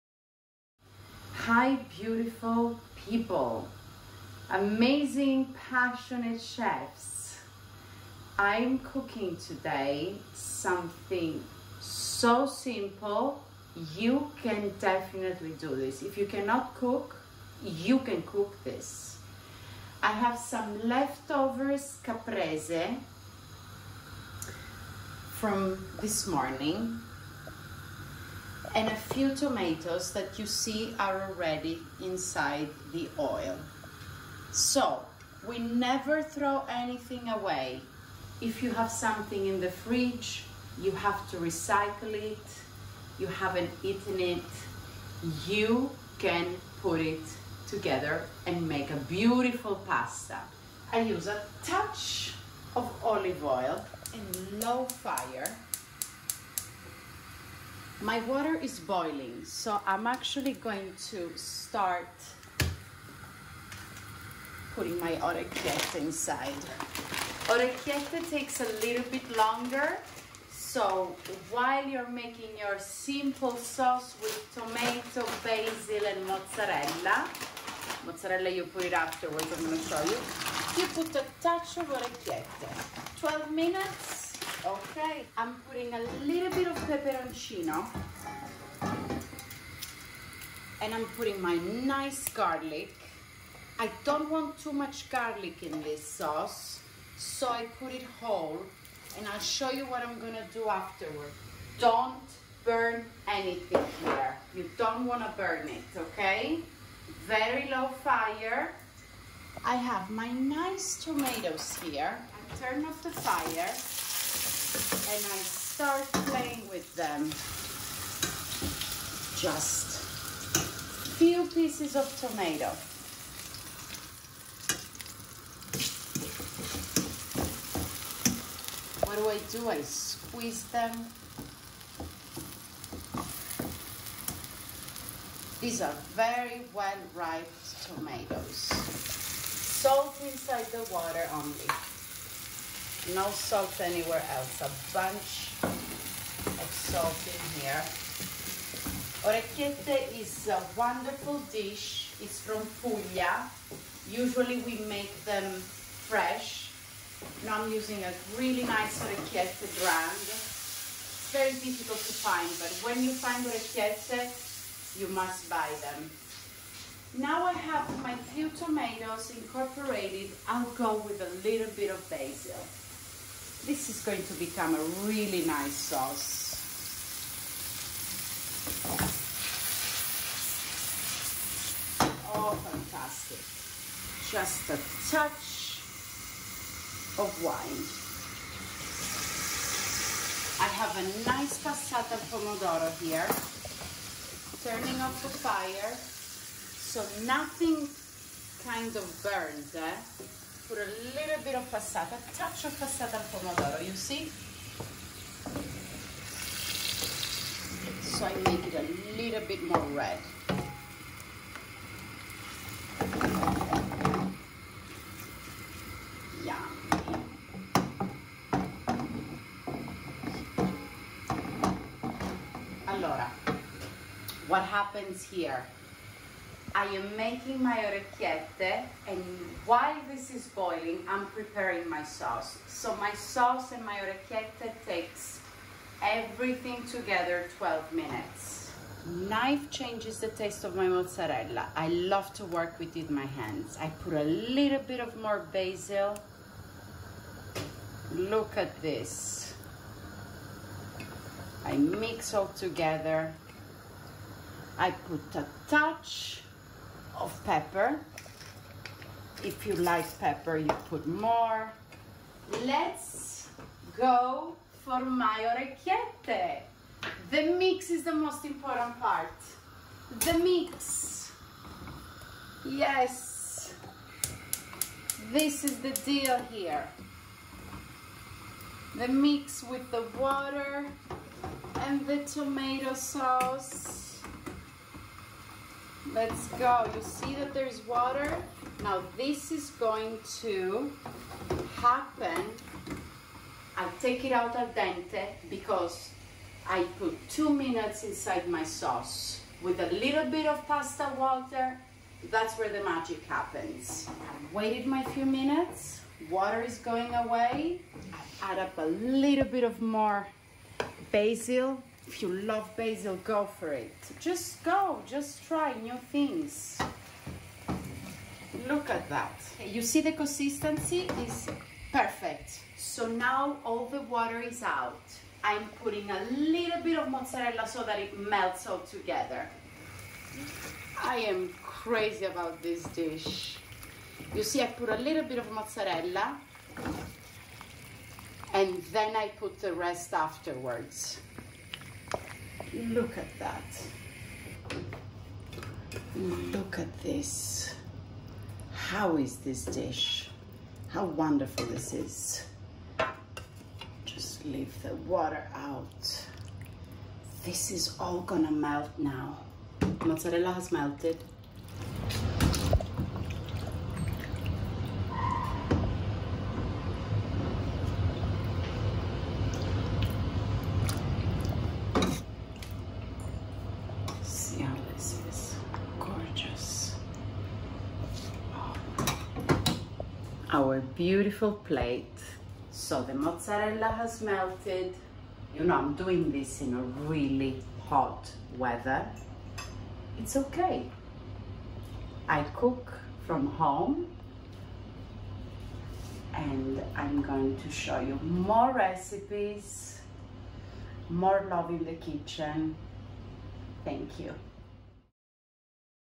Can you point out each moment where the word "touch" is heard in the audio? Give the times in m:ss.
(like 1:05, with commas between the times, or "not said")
0:51, 1:21, 3:05, 3:22, 4:15.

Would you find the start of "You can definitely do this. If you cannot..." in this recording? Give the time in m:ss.
0:13.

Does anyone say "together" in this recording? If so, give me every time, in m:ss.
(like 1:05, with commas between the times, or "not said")
0:47, 3:56, 4:12, 5:28.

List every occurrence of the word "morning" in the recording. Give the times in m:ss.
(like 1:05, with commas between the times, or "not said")
0:26.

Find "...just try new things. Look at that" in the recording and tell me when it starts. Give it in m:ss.
5:15.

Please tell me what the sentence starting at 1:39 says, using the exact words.
And I'll show you what I'm gonna do afterward.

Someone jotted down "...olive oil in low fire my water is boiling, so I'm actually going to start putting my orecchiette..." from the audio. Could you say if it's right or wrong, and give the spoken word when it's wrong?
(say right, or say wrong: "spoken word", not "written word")
right.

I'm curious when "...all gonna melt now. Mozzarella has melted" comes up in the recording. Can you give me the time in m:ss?
5:57.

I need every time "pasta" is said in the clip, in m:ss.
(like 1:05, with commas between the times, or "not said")
0:49, 5:00.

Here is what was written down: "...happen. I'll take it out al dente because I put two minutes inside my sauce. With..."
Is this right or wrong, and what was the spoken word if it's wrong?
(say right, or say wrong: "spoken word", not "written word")
right.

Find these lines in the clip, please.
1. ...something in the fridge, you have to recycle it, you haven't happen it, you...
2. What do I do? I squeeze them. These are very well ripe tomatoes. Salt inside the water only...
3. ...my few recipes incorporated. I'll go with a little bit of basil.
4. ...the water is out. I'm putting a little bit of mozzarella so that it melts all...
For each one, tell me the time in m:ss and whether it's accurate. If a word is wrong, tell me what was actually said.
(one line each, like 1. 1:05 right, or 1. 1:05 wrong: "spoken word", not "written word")
1. 0:38 wrong: "eaten", not "happen"
2. 2:09 right
3. 2:48 wrong: "tomatoes", not "recipes"
4. 5:23 right.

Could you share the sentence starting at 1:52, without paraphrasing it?
I turn off the fire and I start playing with them.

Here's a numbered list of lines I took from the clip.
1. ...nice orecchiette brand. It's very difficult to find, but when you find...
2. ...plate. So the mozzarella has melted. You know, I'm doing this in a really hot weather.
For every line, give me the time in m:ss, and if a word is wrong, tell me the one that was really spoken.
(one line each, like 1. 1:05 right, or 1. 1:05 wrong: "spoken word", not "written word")
1. 2:38 right
2. 6:21 right.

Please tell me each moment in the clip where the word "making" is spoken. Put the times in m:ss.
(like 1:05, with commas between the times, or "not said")
1:12, 3:47.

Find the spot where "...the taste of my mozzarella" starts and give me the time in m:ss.
4:00.